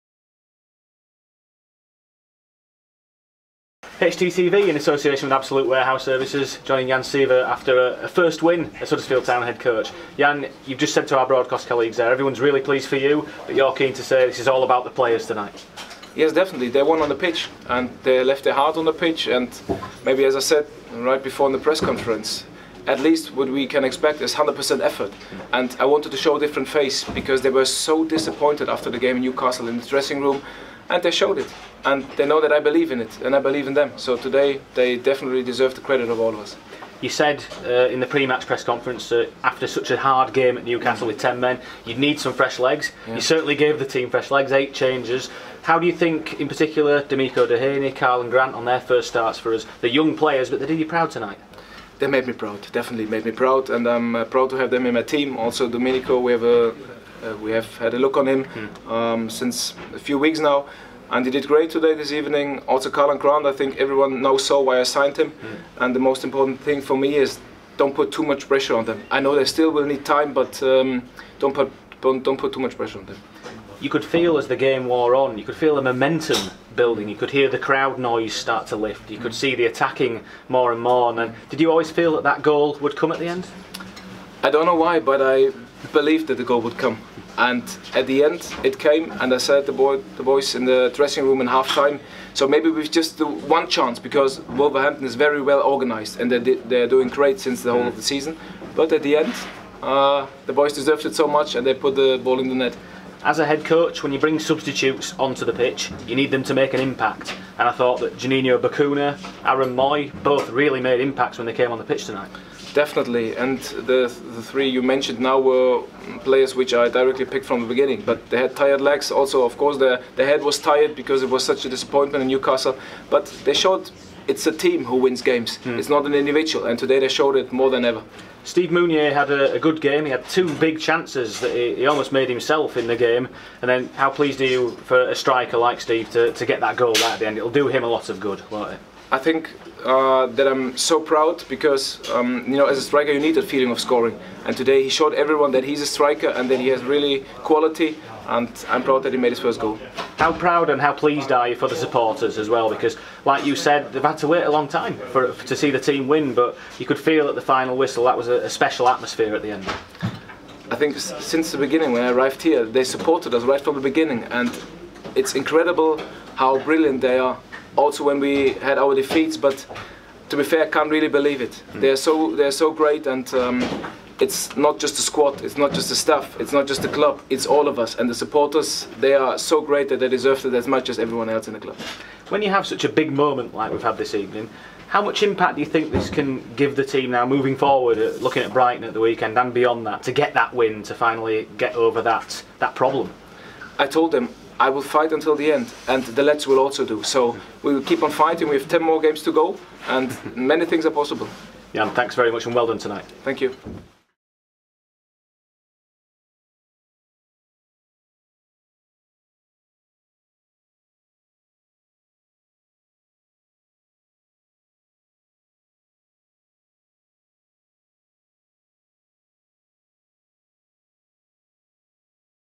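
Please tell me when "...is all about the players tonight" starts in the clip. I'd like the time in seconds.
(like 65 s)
14 s.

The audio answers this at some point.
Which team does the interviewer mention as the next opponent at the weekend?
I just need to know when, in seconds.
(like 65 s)
188 s.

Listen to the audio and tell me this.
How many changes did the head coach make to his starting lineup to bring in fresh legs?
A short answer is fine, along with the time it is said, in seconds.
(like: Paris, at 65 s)
8, at 44 s.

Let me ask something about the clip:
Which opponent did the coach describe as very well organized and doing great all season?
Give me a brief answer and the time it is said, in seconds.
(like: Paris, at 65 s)
Wolverhampton, at 94 s.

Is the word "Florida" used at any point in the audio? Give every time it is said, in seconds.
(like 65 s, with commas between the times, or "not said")
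not said.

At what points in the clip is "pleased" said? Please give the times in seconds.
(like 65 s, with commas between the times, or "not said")
12 s, 134 s, 150 s.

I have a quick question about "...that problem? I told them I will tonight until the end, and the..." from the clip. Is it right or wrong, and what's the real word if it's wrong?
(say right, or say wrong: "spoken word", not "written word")
wrong: "fight", not "tonight".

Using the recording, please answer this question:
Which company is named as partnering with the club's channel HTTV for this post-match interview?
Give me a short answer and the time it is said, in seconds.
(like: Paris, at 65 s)
Absolute Warehouse Services, at 5 s.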